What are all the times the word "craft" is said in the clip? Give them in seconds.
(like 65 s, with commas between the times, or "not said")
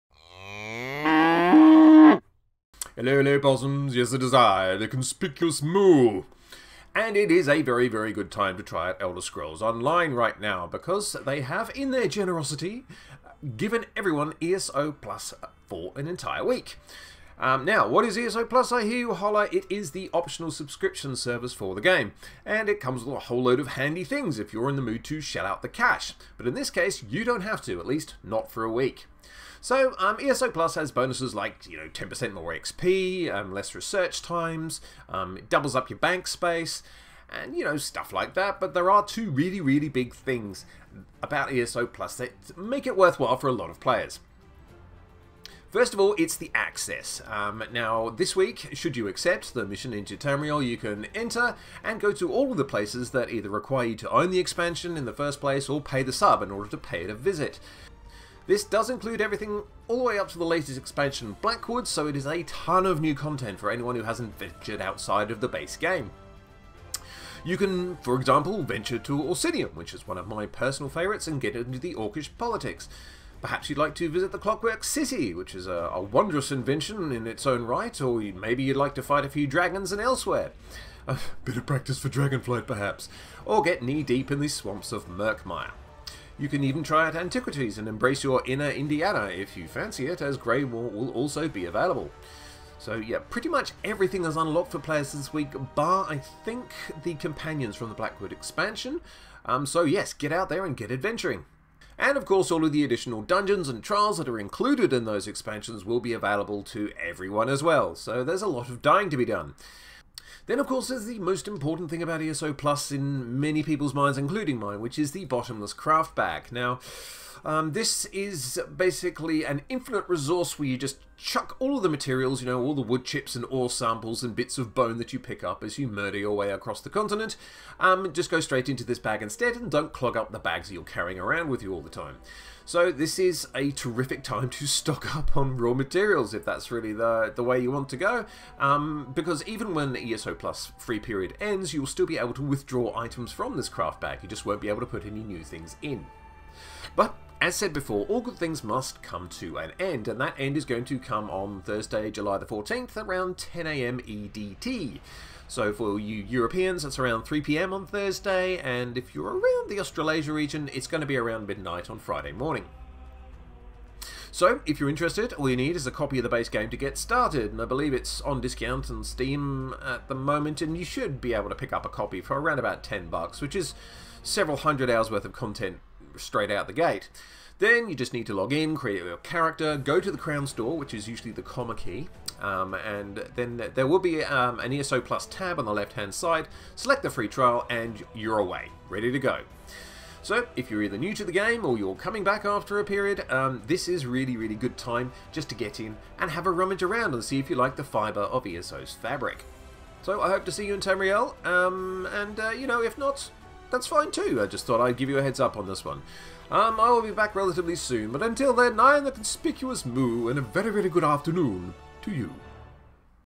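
115 s, 143 s.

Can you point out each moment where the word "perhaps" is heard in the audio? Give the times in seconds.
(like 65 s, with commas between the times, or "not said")
73 s, 82 s.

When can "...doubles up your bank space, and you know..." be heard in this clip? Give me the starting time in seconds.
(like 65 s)
35 s.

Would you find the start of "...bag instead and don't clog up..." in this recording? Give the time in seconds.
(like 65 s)
128 s.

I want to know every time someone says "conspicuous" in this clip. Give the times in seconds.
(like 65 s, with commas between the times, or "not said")
4 s, 209 s.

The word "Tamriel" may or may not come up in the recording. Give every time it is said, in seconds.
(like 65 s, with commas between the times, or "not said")
50 s, 200 s.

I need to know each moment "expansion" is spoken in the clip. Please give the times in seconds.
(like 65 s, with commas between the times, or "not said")
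54 s, 60 s, 98 s, 105 s.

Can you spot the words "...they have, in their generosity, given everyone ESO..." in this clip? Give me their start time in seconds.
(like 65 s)
11 s.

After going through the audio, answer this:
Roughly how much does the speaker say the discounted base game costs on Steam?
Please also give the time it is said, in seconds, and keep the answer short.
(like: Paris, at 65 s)
10 bucks, at 172 s.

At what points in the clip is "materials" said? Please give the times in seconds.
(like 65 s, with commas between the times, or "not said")
121 s, 135 s.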